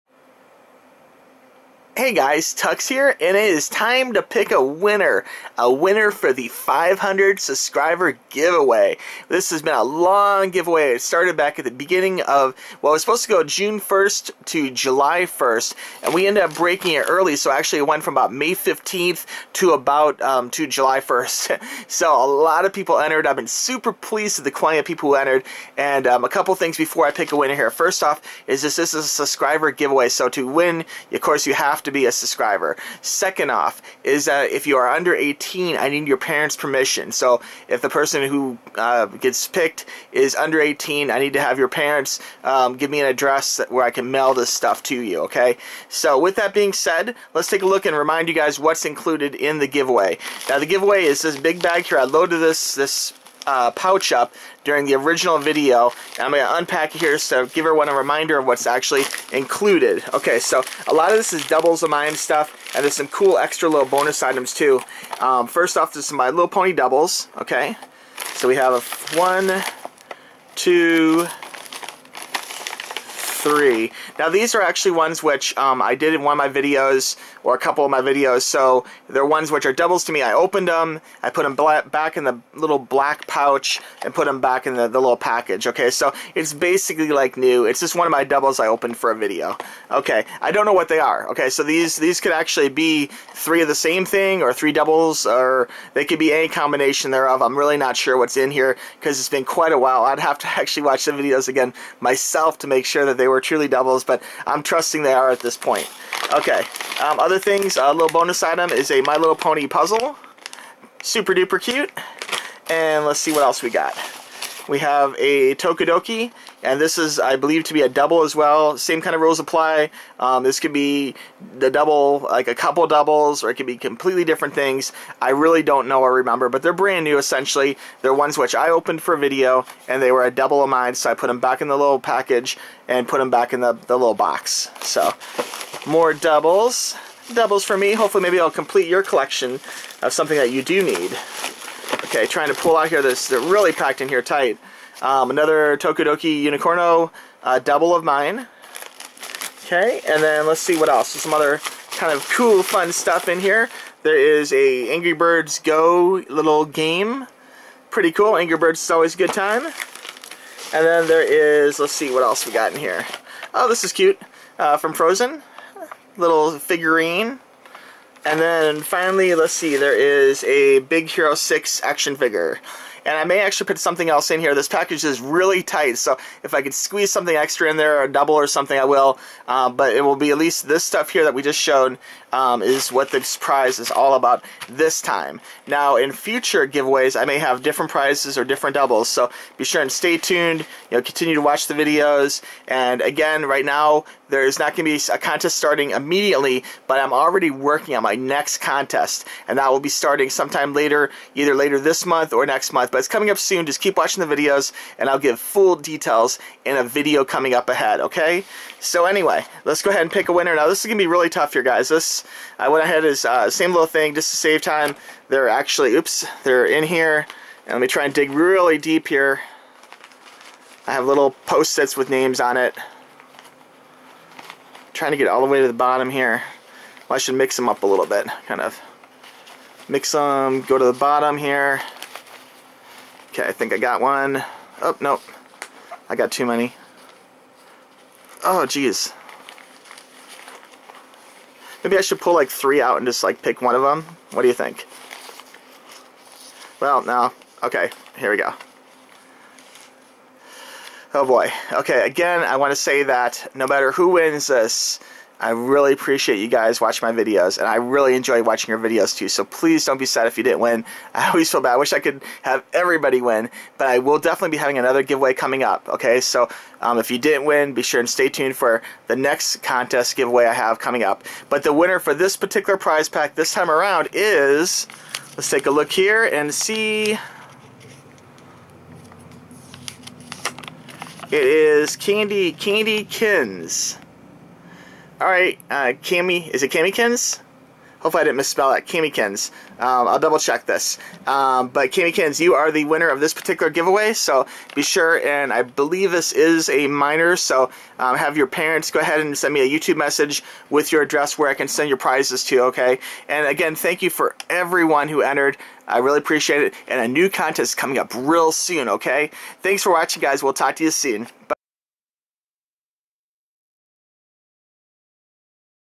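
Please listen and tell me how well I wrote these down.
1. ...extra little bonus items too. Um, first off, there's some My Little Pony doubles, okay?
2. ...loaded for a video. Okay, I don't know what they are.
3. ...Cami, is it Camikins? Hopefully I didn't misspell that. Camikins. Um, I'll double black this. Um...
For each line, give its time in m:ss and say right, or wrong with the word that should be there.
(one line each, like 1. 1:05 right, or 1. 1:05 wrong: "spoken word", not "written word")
1. 1:03 right
2. 1:28 wrong: "opened", not "loaded"
3. 4:46 wrong: "check", not "black".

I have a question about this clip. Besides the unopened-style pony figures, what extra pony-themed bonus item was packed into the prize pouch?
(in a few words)
My Little Pony puzzle.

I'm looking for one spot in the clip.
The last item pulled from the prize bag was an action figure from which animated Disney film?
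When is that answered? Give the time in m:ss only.
2:50.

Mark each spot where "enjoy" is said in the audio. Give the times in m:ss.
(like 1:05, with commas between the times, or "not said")
4:18.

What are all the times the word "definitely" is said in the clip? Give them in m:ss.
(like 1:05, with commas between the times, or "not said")
4:24.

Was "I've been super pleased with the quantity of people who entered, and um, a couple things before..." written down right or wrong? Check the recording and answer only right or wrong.
right.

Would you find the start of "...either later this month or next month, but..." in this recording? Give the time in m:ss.
3:21.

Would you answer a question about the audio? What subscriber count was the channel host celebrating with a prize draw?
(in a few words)
500.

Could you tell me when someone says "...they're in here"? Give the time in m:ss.
3:36.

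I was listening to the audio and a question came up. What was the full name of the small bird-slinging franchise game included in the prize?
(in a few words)
Angry Birds Go.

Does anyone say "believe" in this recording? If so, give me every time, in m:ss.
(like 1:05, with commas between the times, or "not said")
1:57, 4:55.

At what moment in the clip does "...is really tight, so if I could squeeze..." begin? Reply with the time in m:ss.
2:55.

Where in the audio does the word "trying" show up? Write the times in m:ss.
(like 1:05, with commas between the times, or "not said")
2:22, 3:44.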